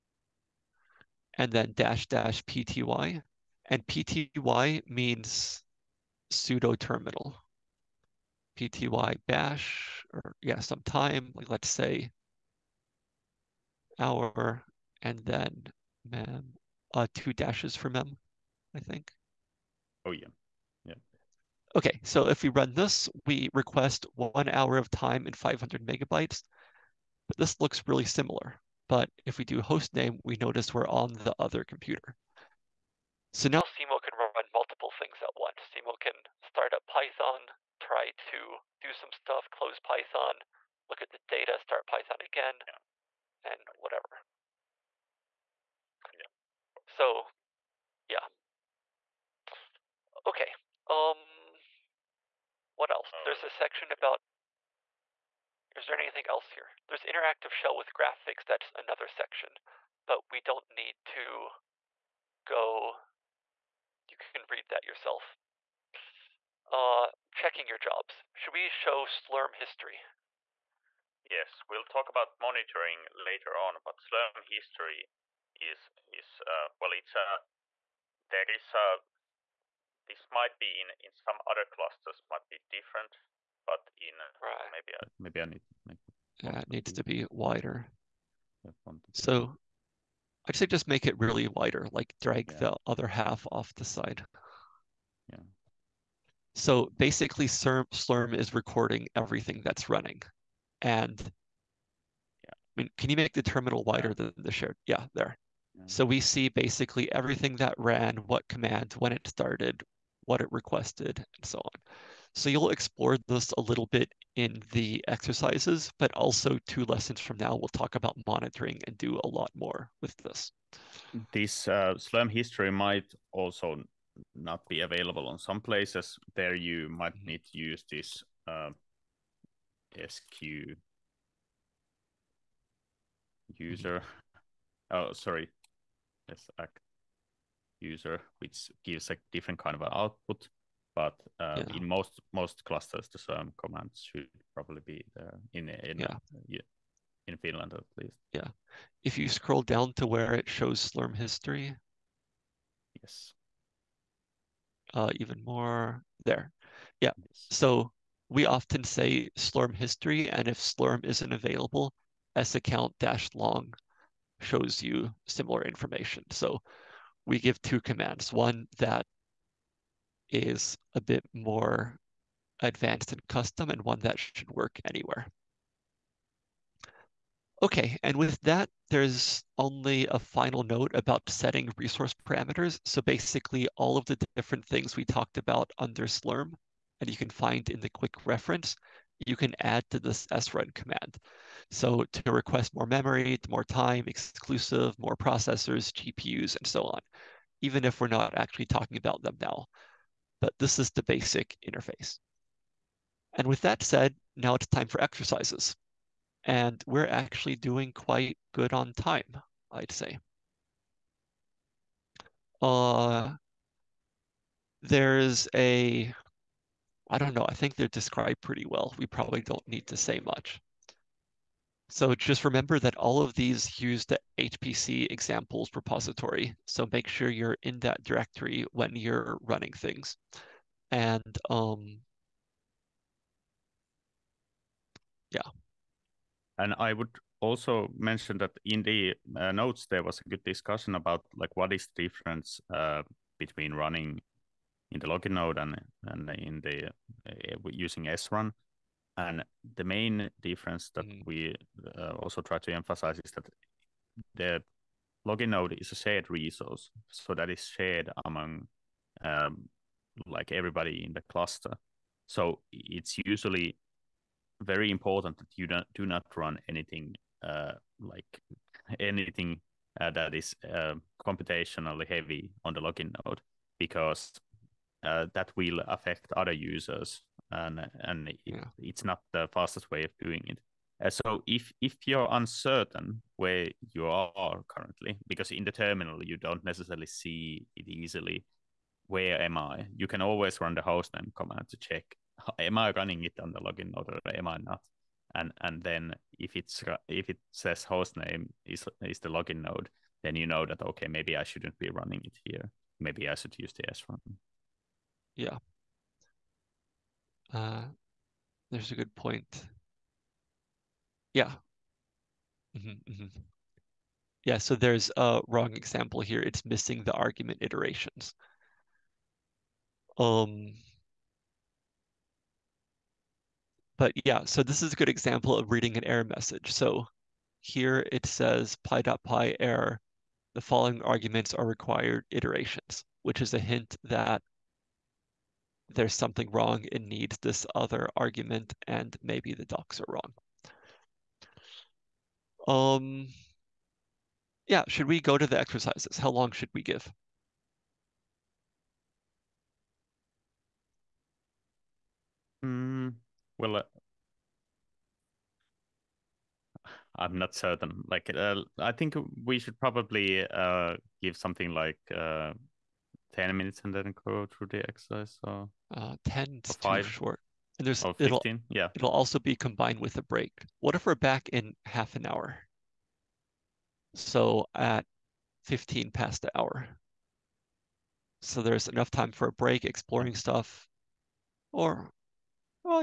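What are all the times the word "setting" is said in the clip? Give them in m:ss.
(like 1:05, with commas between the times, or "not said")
3:01.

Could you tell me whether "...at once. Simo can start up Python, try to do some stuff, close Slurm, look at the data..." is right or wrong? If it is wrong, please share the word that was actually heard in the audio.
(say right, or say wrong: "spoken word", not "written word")
wrong: "Python", not "Slurm".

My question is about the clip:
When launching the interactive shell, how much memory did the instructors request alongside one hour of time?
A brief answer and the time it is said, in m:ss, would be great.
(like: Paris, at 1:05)
500 megabytes, at 0:25.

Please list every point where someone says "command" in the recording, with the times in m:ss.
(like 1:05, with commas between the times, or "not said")
1:48, 2:23, 2:47, 3:10, 4:51.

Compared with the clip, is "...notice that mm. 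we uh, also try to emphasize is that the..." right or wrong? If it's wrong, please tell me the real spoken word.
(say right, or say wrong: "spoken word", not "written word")
wrong: "difference", not "notice".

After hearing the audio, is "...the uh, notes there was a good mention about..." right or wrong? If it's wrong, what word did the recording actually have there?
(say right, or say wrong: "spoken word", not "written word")
wrong: "discussion", not "mention".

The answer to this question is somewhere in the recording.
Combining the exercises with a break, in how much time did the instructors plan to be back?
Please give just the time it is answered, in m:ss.
6:11.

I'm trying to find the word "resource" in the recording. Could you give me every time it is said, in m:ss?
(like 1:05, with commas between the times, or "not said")
3:01, 4:16.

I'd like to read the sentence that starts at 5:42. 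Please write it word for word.
Um, yeah, should we go to the exercises?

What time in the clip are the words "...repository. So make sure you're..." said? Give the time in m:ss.
3:45.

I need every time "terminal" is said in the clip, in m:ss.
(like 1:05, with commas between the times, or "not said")
0:06, 1:43, 4:45.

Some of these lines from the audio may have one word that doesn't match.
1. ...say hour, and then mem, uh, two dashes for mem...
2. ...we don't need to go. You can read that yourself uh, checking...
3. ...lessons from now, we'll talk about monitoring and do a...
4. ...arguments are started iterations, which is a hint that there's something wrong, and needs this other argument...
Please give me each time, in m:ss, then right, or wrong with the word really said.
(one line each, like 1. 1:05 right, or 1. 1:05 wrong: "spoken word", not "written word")
1. 0:11 right
2. 1:00 right
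3. 1:56 right
4. 5:31 wrong: "required", not "started".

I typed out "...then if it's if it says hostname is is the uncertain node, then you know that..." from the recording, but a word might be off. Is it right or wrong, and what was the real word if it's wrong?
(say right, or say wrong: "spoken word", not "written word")
wrong: "login", not "uncertain".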